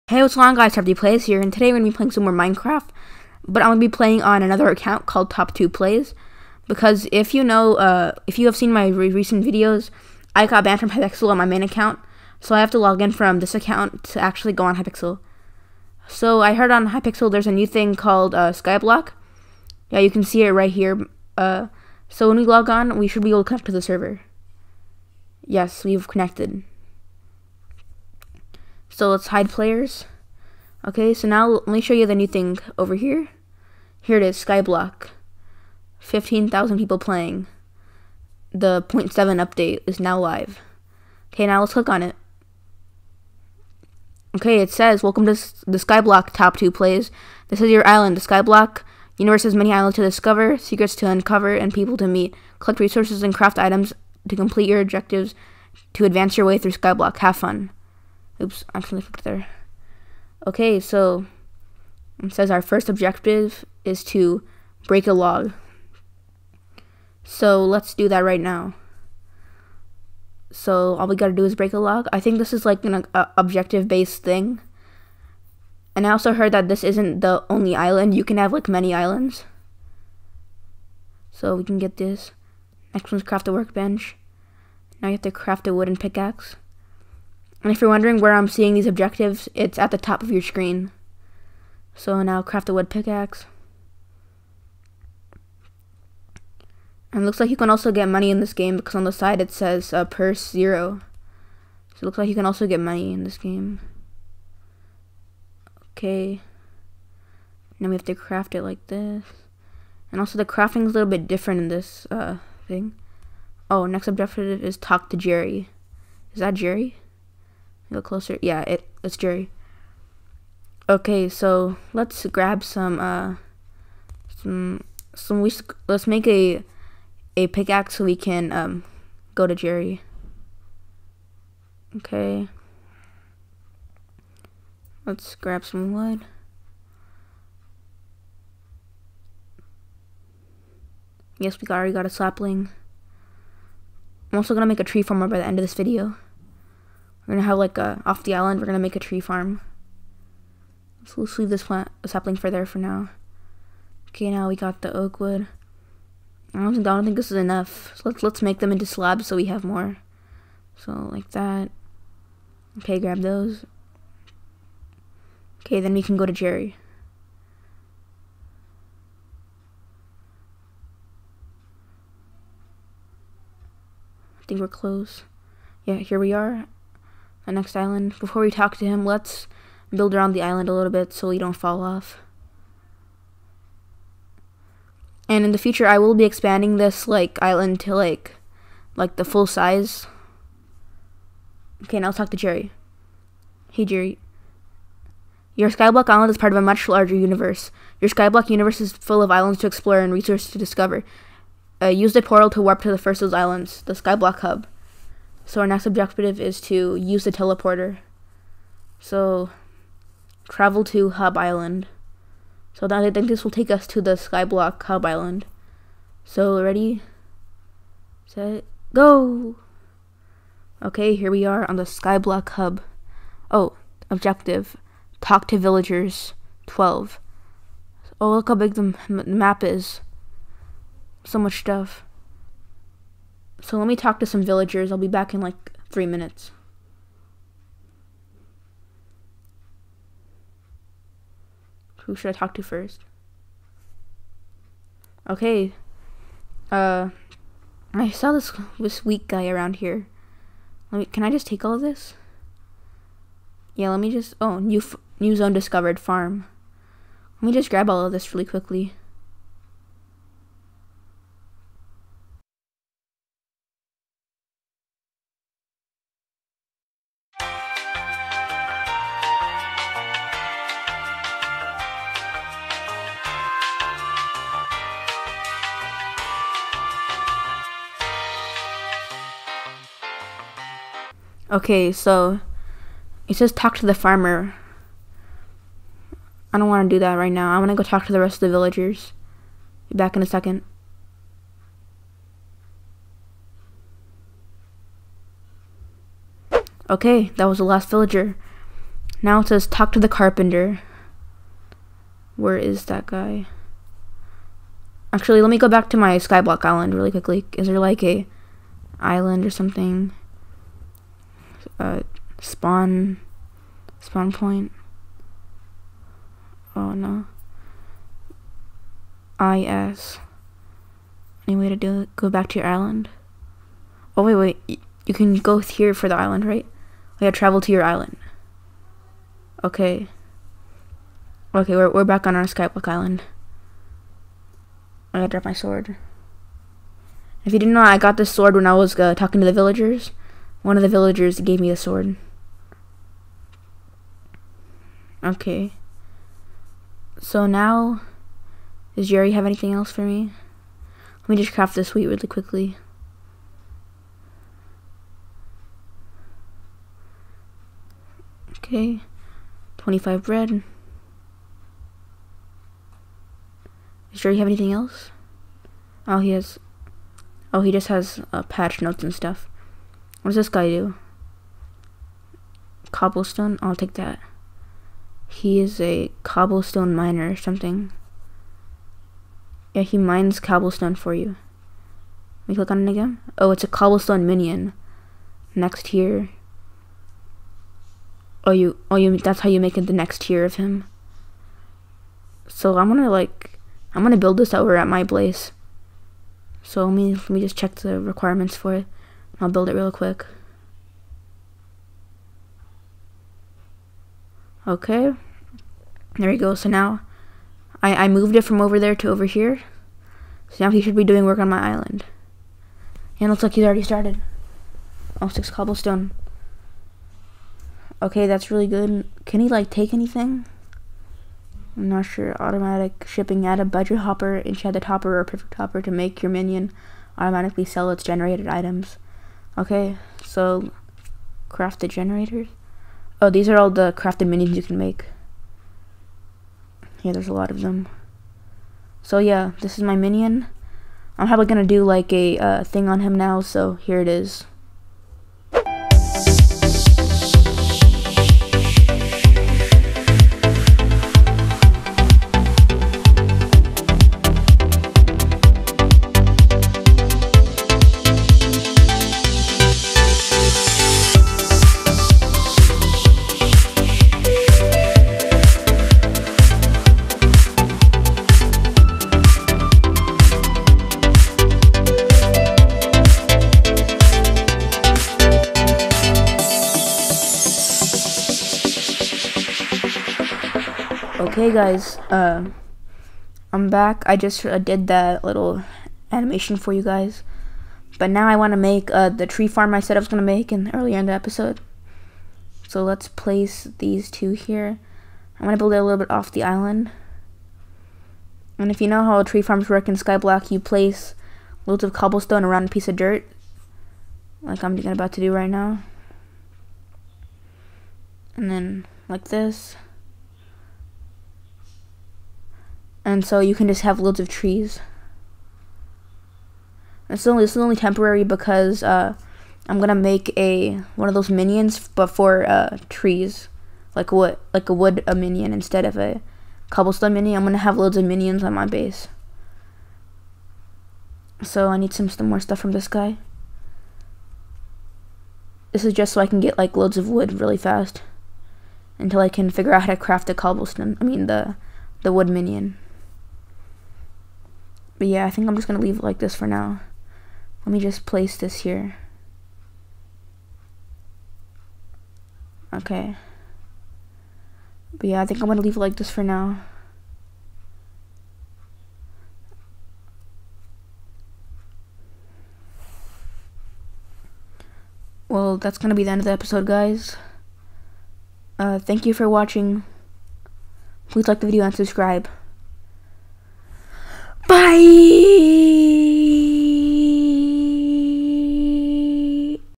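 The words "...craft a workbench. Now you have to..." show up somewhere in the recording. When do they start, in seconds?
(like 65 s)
83 s.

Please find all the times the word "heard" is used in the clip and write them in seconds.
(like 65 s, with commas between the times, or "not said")
16 s, 76 s.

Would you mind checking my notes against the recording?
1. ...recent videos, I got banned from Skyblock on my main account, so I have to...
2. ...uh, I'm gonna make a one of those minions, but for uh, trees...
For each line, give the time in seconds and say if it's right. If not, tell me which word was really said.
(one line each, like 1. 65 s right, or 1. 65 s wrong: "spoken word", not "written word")
1. 9 s wrong: "Hypixel", not "Skyblock"
2. 518 s right.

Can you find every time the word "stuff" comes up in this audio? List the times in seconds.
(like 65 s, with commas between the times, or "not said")
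231 s, 369 s, 532 s.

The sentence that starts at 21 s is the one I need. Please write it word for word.
Uh, so when we log on, we should be able to connect to the server.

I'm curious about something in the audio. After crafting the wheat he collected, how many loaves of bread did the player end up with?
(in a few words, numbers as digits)
25.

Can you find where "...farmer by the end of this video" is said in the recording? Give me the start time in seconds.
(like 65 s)
145 s.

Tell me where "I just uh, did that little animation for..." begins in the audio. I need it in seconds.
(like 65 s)
484 s.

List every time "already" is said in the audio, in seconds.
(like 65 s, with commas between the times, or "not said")
141 s, 413 s.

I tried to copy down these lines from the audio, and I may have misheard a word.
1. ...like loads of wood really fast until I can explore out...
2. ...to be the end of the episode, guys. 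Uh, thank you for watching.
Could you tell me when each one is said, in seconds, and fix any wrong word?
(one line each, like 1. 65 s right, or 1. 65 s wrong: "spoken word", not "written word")
1. 536 s wrong: "figure", not "explore"
2. 565 s right.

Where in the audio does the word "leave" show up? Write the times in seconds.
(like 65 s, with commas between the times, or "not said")
151 s, 545 s, 555 s.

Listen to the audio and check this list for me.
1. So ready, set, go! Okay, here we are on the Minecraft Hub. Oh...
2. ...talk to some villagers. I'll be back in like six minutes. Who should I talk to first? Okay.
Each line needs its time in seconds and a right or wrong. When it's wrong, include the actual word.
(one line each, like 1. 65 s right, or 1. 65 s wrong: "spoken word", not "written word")
1. 216 s wrong: "Skyblock", not "Minecraft"
2. 233 s wrong: "three", not "six".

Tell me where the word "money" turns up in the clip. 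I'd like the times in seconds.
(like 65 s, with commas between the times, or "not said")
98 s, 102 s.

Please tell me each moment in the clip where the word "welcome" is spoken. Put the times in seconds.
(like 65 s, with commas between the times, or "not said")
45 s.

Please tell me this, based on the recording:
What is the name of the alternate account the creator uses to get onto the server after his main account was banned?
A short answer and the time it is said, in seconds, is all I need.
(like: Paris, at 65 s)
Top 2 Plays, at 5 s.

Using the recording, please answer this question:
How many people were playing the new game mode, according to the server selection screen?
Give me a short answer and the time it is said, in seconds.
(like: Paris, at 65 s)
15,000, at 35 s.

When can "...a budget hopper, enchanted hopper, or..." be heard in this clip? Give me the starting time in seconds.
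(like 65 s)
423 s.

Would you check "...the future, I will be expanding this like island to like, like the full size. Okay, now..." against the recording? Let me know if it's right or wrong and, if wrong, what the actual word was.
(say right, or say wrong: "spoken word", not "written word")
right.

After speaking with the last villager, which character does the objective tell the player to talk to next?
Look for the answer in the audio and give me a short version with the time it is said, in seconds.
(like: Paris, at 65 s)
The carpenter, at 299 s.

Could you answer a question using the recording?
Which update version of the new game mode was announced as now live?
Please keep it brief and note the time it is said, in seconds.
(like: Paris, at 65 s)
0.7, at 38 s.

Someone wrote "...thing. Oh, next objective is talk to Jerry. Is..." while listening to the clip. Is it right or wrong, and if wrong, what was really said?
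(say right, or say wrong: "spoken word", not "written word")
right.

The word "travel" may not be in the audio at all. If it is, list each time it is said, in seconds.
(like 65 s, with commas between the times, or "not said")
210 s, 327 s.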